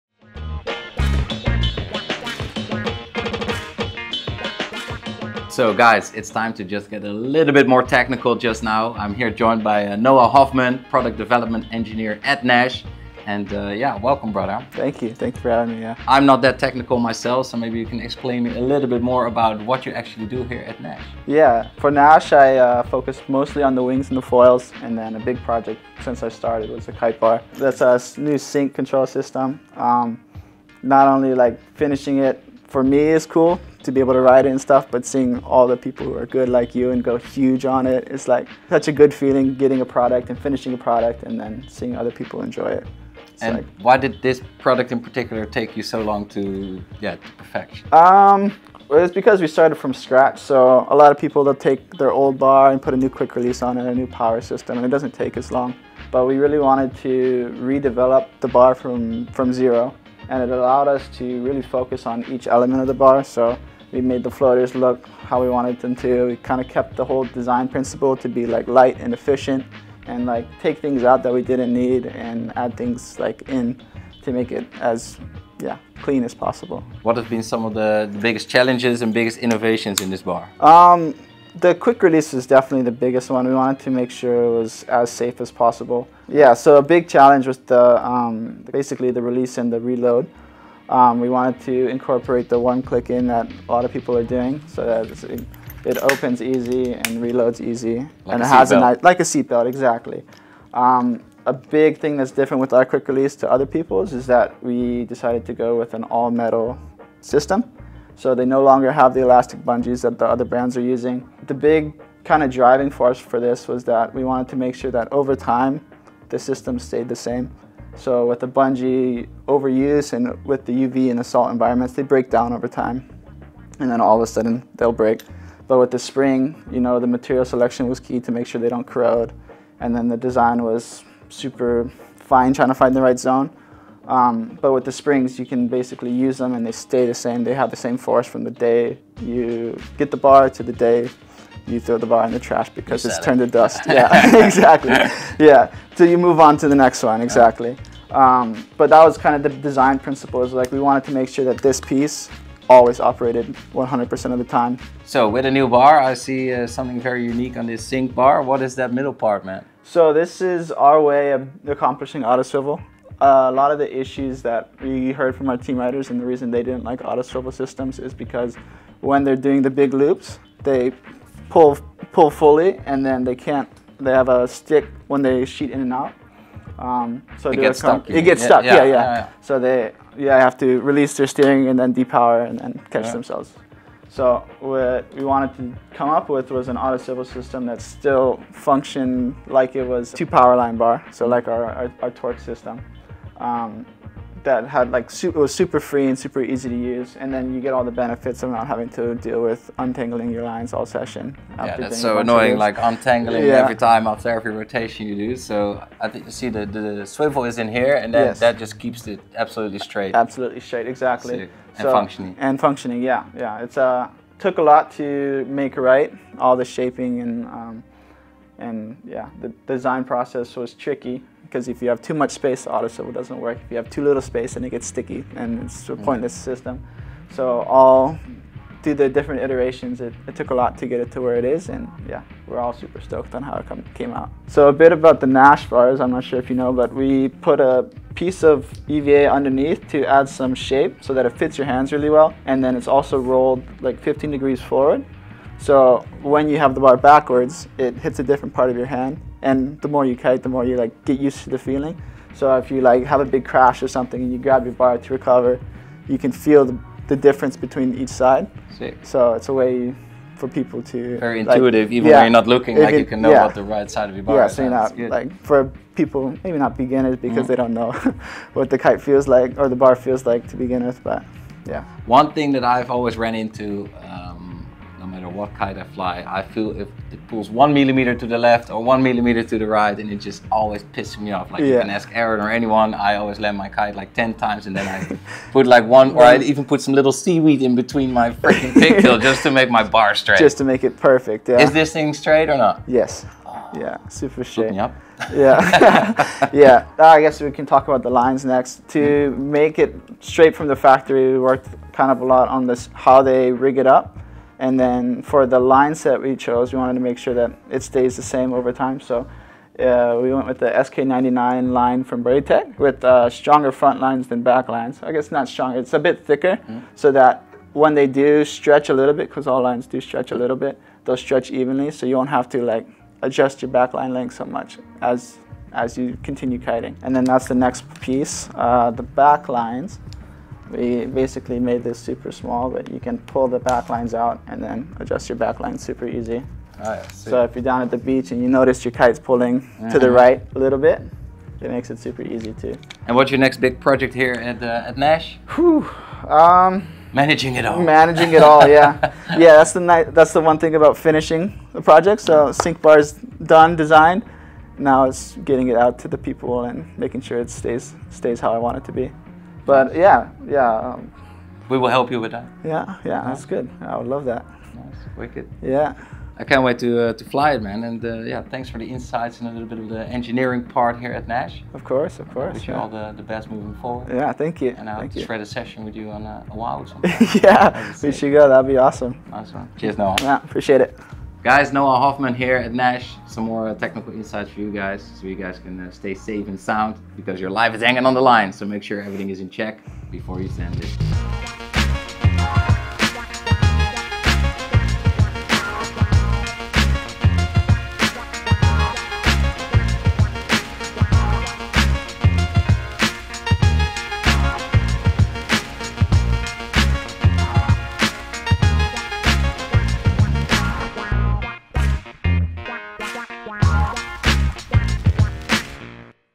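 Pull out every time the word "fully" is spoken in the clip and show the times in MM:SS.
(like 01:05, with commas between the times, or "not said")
02:52.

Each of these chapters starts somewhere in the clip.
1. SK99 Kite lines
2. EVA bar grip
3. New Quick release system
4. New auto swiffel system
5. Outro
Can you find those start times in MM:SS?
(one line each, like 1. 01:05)
1. 04:55
2. 03:55
3. 01:22
4. 02:38
5. 06:05.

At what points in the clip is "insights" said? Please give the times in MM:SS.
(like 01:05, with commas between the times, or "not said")
06:08, 06:24.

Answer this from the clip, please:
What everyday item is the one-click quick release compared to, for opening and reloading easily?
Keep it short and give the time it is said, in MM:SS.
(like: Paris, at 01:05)
A seatbelt, at 01:39.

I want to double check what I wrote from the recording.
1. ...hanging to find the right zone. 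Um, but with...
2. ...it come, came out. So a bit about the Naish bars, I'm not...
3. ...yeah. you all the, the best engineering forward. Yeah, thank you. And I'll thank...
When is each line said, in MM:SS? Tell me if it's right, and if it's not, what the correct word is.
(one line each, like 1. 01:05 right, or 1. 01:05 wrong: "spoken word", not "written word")
1. 02:12 wrong: "trying", not "hanging"
2. 03:53 right
3. 06:12 wrong: "moving", not "engineering".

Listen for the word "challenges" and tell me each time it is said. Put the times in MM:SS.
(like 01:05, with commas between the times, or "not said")
01:18, 01:27.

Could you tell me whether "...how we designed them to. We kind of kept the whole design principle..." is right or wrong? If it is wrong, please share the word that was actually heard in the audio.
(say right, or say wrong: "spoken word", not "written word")
wrong: "wanted", not "designed".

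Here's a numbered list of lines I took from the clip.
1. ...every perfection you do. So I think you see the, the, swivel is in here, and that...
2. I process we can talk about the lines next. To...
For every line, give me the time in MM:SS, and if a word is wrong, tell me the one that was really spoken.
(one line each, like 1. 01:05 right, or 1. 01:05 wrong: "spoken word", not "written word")
1. 03:24 wrong: "rotation", not "perfection"
2. 04:56 wrong: "guess", not "process".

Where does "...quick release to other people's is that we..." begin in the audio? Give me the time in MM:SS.
01:42.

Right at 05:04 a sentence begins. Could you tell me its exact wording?
And then for the line set we chose, we wanted to make sure that it stays the same over time.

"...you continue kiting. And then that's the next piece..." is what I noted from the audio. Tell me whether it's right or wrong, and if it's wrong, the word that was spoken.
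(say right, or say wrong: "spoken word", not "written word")
right.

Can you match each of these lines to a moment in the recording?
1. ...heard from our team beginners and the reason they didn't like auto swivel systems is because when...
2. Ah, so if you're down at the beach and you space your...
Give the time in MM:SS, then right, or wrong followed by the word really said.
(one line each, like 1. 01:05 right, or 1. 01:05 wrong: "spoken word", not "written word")
1. 02:45 wrong: "riders", not "beginners"
2. 05:36 wrong: "notice", not "space".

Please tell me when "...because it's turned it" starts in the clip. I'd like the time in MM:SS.
02:22.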